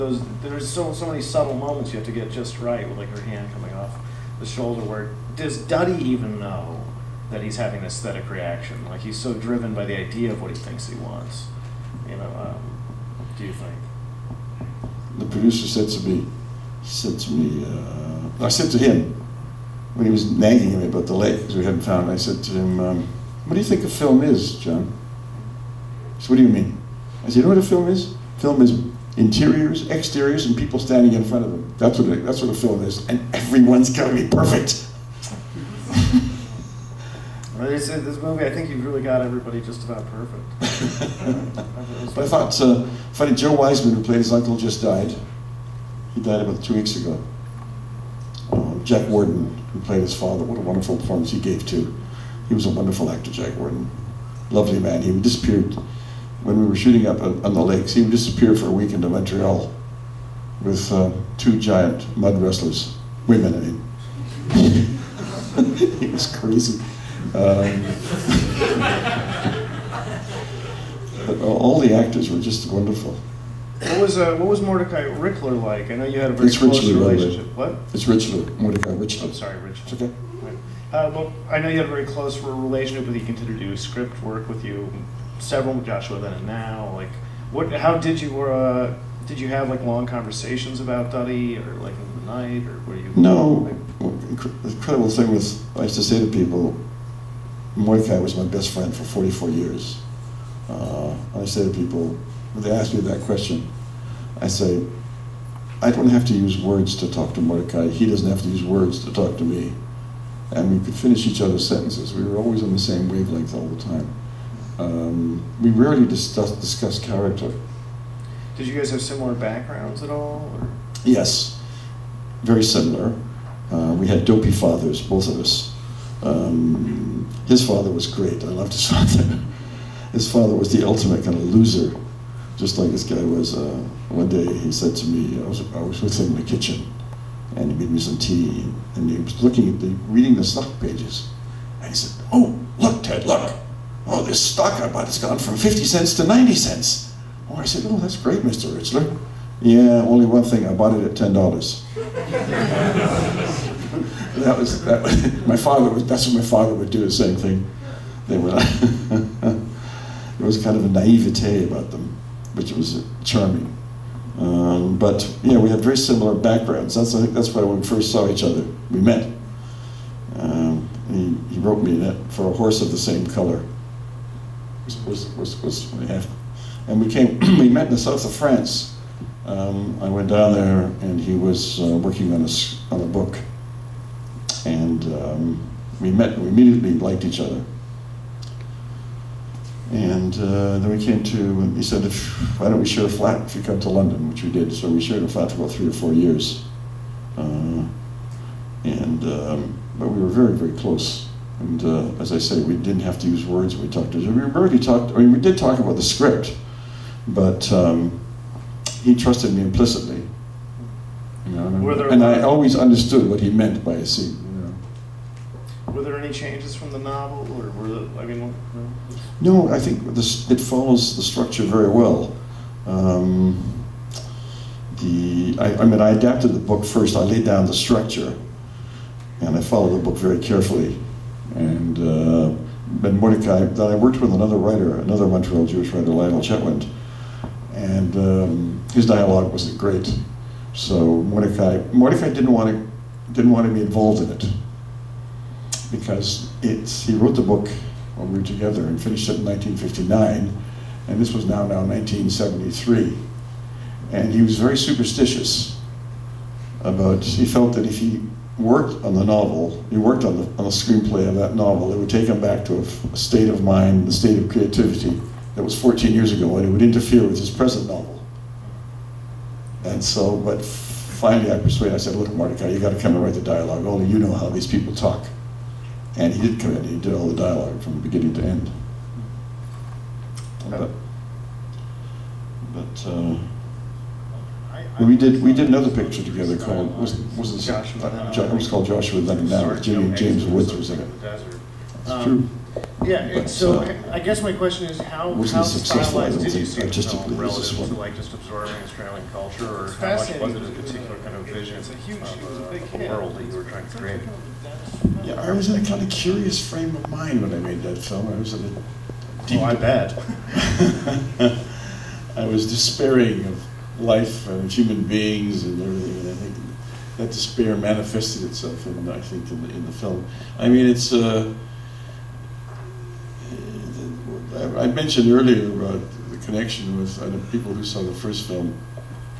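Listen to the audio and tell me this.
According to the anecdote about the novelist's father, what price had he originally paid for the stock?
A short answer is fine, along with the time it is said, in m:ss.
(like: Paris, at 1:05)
$10, at 2:31.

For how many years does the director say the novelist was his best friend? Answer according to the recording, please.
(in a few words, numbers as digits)
44.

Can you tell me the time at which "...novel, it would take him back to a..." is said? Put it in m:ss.
4:21.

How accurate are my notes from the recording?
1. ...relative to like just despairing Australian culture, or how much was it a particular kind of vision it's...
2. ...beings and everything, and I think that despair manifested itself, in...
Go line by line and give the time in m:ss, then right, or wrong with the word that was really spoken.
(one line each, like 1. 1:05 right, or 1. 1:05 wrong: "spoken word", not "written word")
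1. 4:57 wrong: "absorbing", not "despairing"
2. 5:15 right.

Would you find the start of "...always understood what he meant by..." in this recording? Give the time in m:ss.
3:32.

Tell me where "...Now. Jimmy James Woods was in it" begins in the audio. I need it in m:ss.
4:49.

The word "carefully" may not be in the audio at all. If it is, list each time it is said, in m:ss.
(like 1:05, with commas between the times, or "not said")
3:50.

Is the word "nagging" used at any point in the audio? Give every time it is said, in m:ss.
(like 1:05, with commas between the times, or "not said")
0:20.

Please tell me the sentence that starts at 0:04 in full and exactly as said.
Where does Duddy even know that he's having an aesthetic reaction?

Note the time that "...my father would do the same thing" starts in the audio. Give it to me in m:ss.
2:36.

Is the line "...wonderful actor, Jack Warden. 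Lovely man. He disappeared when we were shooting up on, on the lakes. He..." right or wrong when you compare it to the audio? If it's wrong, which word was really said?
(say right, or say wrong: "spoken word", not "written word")
right.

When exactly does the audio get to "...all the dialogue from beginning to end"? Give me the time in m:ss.
4:37.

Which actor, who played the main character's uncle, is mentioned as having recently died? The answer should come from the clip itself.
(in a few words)
Joe Wiseman.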